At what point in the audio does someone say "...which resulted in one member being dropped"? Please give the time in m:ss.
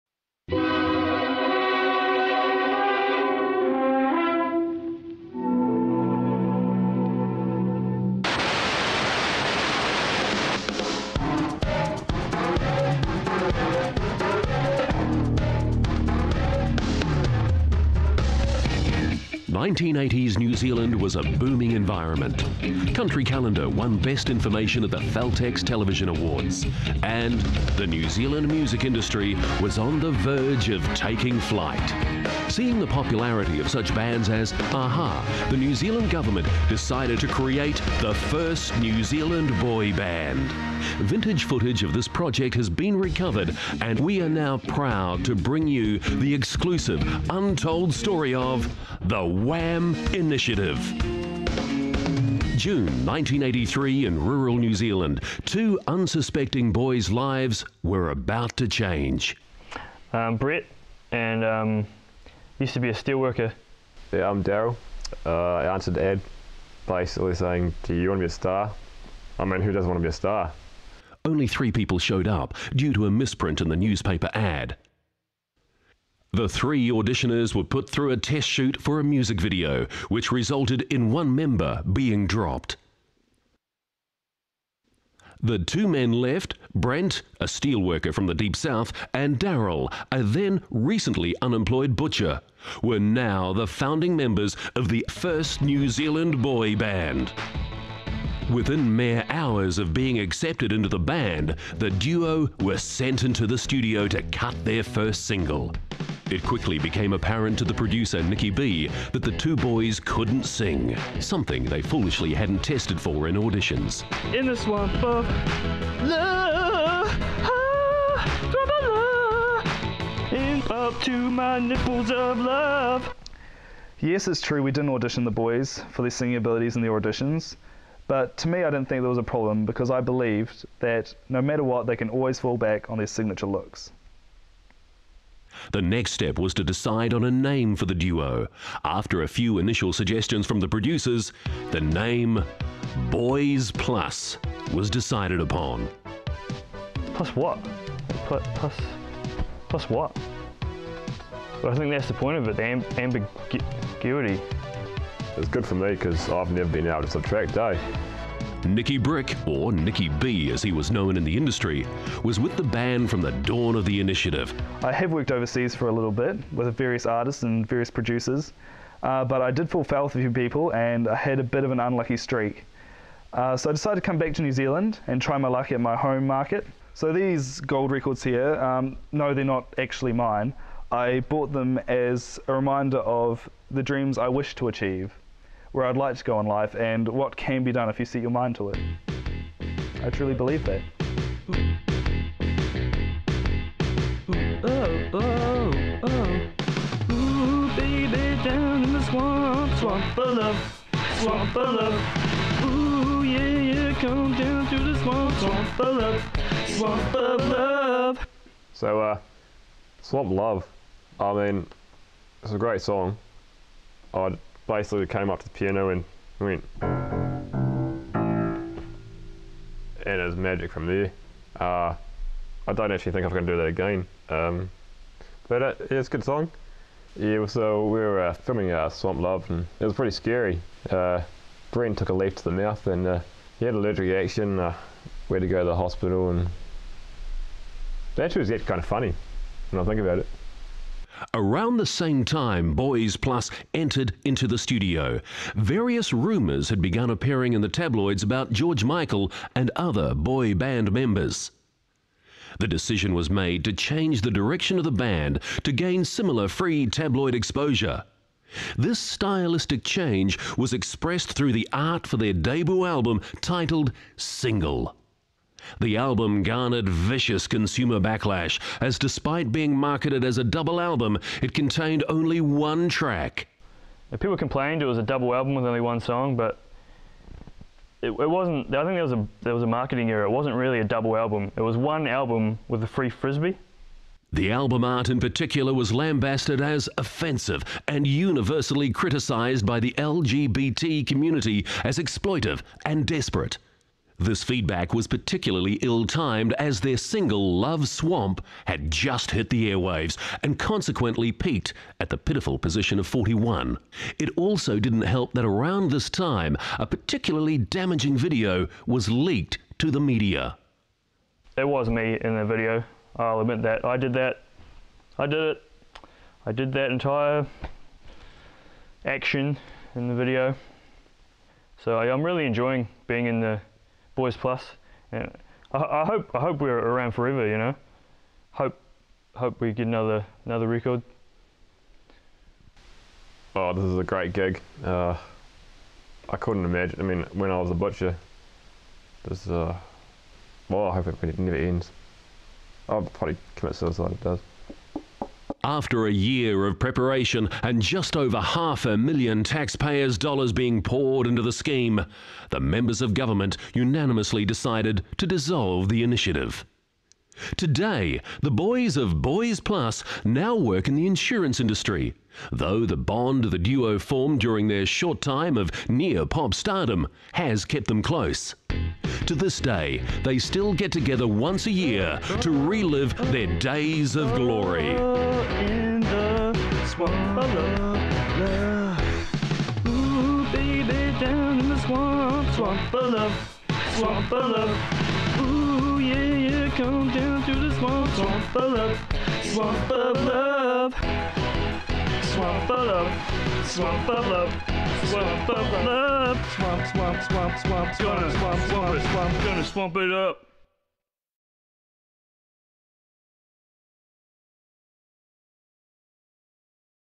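1:20.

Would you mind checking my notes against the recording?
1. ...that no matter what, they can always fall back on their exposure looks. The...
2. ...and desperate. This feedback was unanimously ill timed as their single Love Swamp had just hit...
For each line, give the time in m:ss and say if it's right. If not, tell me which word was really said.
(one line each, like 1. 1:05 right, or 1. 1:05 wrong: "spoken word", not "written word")
1. 2:10 wrong: "signature", not "exposure"
2. 4:52 wrong: "particularly", not "unanimously".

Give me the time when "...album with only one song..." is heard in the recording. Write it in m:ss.
4:35.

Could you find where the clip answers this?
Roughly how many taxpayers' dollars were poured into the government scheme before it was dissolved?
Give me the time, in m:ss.
5:48.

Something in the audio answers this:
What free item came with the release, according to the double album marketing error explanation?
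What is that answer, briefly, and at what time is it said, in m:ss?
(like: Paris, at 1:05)
frisbee, at 4:43.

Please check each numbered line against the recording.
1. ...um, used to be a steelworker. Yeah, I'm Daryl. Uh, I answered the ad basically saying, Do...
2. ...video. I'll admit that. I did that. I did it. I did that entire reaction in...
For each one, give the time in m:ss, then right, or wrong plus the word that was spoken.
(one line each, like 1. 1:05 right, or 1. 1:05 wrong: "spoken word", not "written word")
1. 1:01 right
2. 5:12 wrong: "action", not "reaction".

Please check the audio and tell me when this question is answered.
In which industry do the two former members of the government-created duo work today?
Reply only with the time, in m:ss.
6:01.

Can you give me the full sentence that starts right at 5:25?
And I, I hope I hope we're around forever.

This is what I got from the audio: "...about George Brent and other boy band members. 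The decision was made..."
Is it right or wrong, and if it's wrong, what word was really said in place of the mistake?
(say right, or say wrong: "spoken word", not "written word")
wrong: "Michael", not "Brent".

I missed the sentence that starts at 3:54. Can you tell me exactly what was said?
Uh, we had to go to the hospital and that actually was yet kind of funny when I think about it.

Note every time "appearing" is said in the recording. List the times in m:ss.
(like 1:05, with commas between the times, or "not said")
4:07.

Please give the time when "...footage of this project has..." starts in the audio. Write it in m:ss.
0:41.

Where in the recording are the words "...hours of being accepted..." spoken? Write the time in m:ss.
1:39.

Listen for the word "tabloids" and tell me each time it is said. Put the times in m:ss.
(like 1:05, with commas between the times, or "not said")
4:07, 4:16.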